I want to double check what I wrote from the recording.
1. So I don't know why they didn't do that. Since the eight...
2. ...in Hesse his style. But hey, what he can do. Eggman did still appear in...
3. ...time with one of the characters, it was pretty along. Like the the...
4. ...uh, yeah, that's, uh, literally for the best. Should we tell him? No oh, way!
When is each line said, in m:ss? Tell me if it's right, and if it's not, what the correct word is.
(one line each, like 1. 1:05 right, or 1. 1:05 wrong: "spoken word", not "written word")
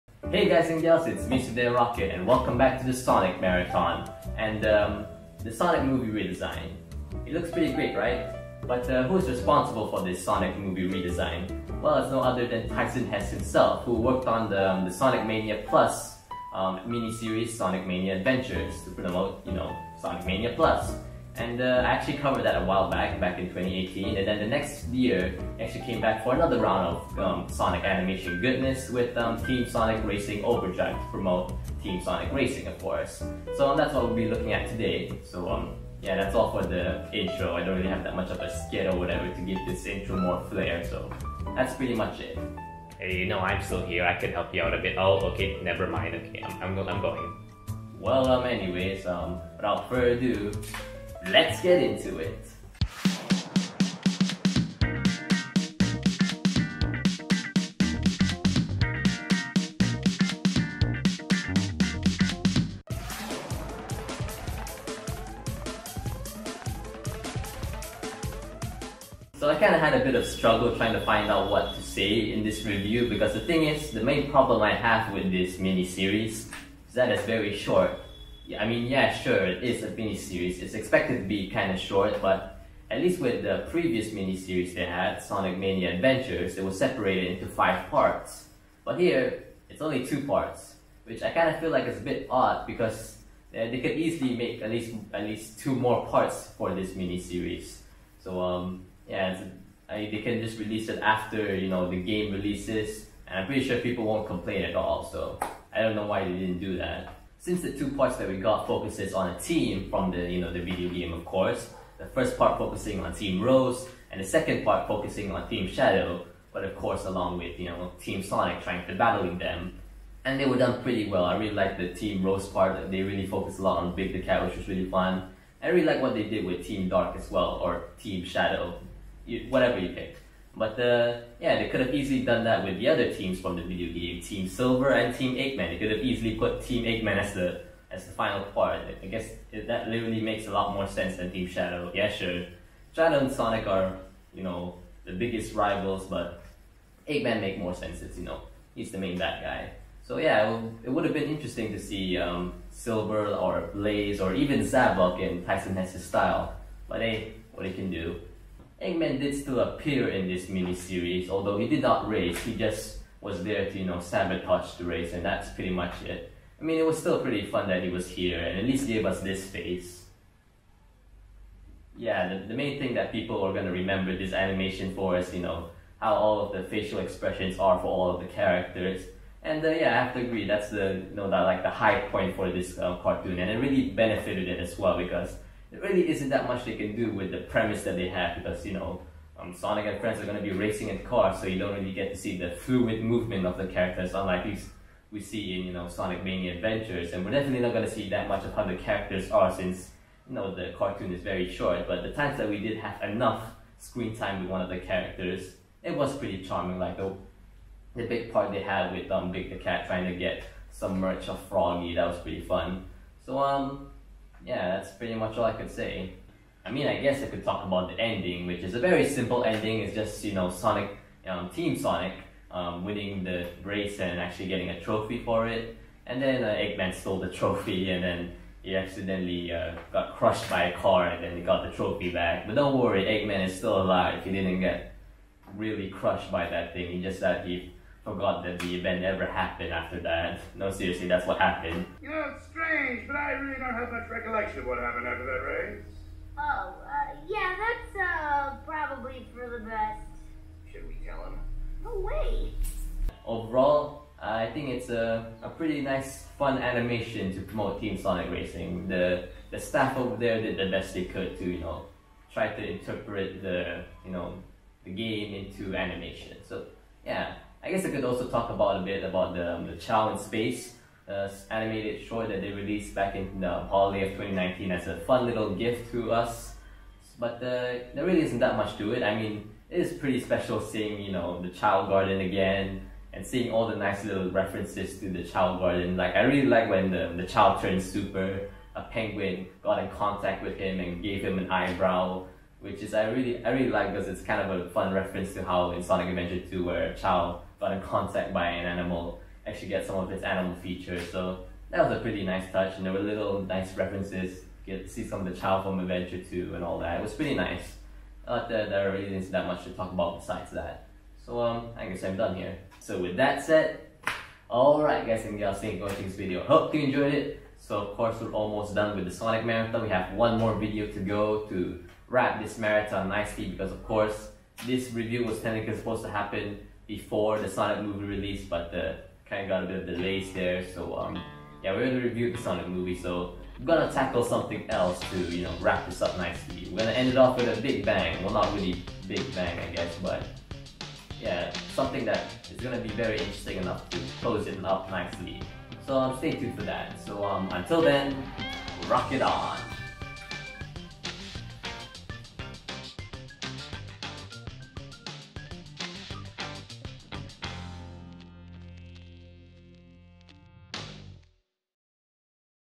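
1. 1:45 wrong: "two", not "eight"
2. 2:35 wrong: "Tyson", not "Hesse"
3. 3:24 wrong: "charming", not "along"
4. 4:06 wrong: "probably", not "literally".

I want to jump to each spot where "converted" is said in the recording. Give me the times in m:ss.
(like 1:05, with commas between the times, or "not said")
not said.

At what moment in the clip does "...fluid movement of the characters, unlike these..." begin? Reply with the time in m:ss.
3:12.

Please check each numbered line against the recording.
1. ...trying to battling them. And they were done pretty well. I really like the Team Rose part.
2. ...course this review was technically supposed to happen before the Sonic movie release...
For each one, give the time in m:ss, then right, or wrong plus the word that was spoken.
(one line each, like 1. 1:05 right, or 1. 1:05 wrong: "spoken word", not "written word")
1. 1:58 right
2. 5:23 right.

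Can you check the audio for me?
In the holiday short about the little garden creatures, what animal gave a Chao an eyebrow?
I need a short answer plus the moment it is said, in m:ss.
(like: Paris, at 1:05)
A penguin, at 4:48.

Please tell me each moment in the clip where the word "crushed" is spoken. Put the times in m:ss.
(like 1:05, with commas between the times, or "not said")
3:50, 3:55.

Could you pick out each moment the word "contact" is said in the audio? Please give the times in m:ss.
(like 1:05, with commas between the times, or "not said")
4:49, 4:57.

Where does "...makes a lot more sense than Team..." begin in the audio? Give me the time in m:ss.
2:20.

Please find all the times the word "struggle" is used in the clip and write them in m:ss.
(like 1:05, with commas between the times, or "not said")
1:10.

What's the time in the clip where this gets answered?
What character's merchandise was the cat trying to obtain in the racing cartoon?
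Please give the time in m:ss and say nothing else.
3:31.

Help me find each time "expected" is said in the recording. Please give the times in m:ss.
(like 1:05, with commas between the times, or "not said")
1:20.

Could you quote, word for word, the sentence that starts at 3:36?
I mean, I guess I could talk about the ending, which is a very simple ending.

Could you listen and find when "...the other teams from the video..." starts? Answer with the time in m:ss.
2:12.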